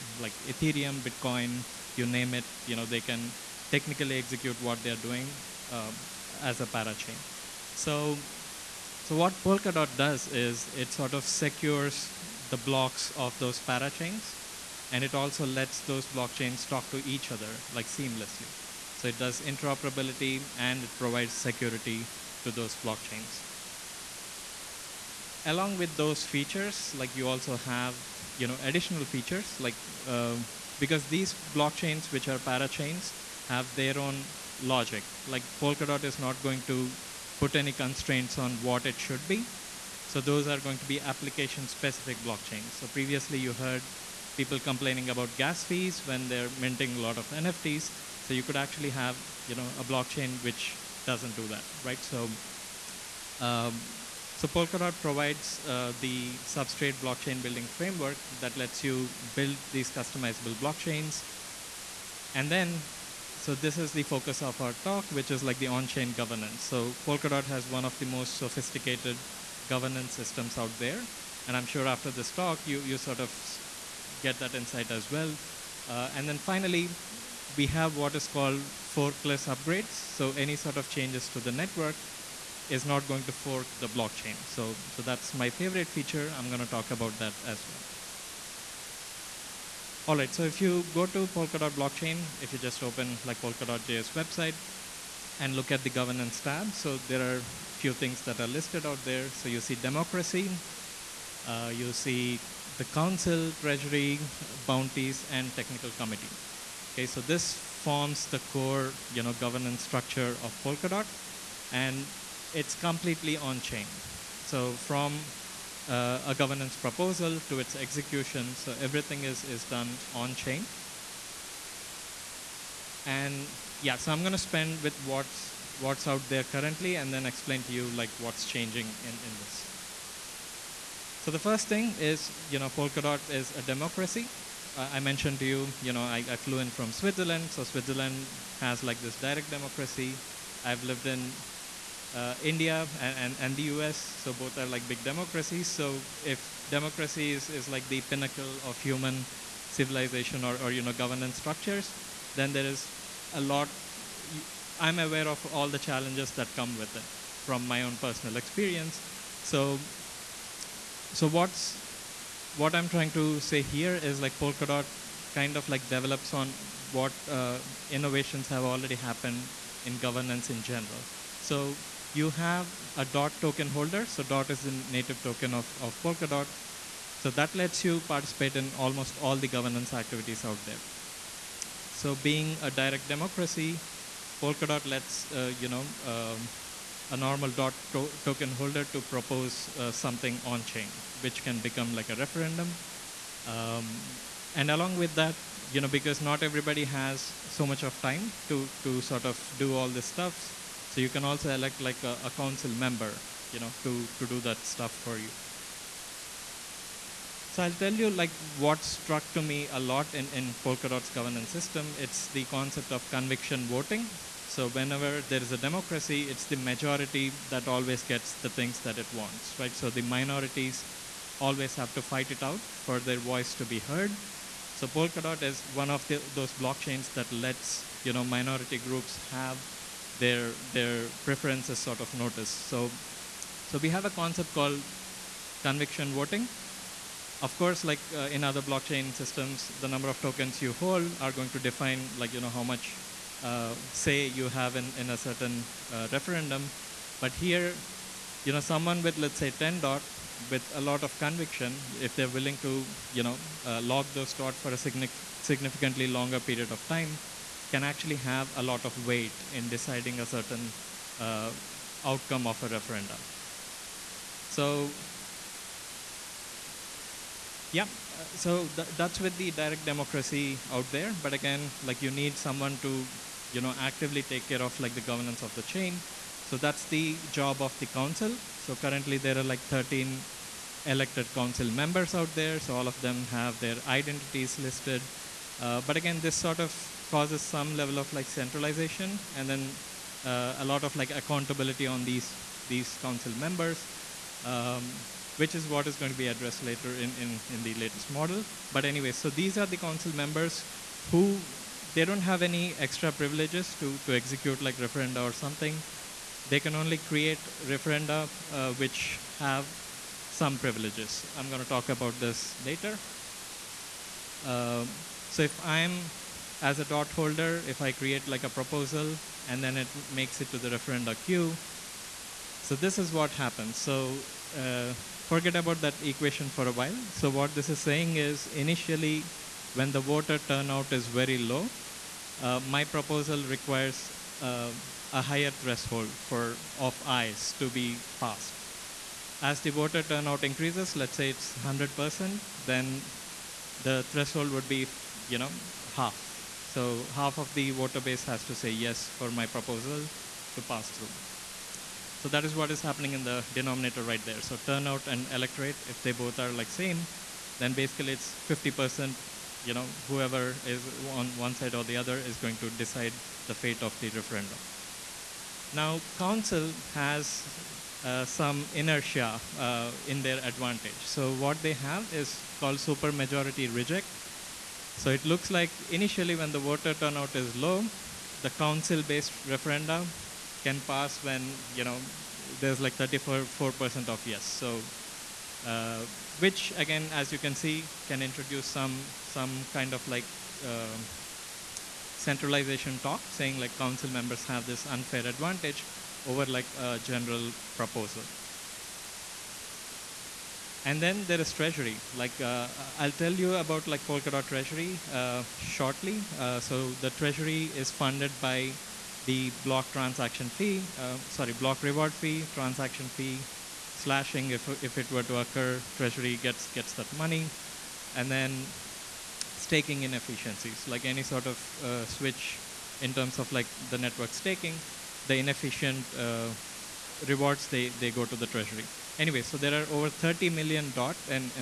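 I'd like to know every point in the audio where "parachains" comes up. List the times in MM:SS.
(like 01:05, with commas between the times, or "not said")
00:06, 00:13, 00:32.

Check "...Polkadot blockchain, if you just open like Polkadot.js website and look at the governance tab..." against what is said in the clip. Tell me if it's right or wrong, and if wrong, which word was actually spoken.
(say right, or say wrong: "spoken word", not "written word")
right.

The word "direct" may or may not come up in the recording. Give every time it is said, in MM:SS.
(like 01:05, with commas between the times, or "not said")
02:19, 03:02, 04:29.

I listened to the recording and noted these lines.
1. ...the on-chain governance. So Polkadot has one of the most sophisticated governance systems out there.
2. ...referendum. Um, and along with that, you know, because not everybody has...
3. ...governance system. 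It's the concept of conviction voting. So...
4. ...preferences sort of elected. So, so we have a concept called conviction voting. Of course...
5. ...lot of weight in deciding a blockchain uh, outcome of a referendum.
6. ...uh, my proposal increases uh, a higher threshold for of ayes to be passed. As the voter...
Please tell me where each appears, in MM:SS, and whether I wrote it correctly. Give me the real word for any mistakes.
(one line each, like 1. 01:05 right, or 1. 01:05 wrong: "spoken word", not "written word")
1. 01:05 right
2. 03:12 right
3. 03:31 right
4. 03:51 wrong: "noticed", not "elected"
5. 04:18 wrong: "certain", not "blockchain"
6. 05:32 wrong: "requires", not "increases".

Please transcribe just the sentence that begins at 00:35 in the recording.
Like Polkadot is not going to put any constraints on what it should be.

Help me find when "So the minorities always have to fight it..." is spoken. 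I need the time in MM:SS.
03:39.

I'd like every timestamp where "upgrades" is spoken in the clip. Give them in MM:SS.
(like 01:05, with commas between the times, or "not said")
01:19.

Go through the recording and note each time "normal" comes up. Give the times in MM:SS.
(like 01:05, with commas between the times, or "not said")
03:07.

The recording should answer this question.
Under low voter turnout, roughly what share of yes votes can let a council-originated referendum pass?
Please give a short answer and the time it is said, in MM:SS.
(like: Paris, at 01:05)
34%, at 06:22.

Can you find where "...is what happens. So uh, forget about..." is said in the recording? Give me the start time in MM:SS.
05:22.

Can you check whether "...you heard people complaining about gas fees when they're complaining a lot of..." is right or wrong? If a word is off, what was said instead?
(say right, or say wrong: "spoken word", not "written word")
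wrong: "minting", not "complaining".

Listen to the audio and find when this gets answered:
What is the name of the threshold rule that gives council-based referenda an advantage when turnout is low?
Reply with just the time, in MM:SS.
06:12.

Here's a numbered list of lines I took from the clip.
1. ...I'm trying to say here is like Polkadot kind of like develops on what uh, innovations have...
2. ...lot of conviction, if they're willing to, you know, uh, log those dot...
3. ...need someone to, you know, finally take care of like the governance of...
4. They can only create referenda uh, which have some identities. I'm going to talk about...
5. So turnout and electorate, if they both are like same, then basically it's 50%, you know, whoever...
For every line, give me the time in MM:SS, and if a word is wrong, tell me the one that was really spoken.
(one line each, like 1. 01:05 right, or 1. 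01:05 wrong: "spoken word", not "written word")
1. 02:42 right
2. 04:10 right
3. 04:32 wrong: "actively", not "finally"
4. 05:06 wrong: "privileges", not "identities"
5. 05:54 right.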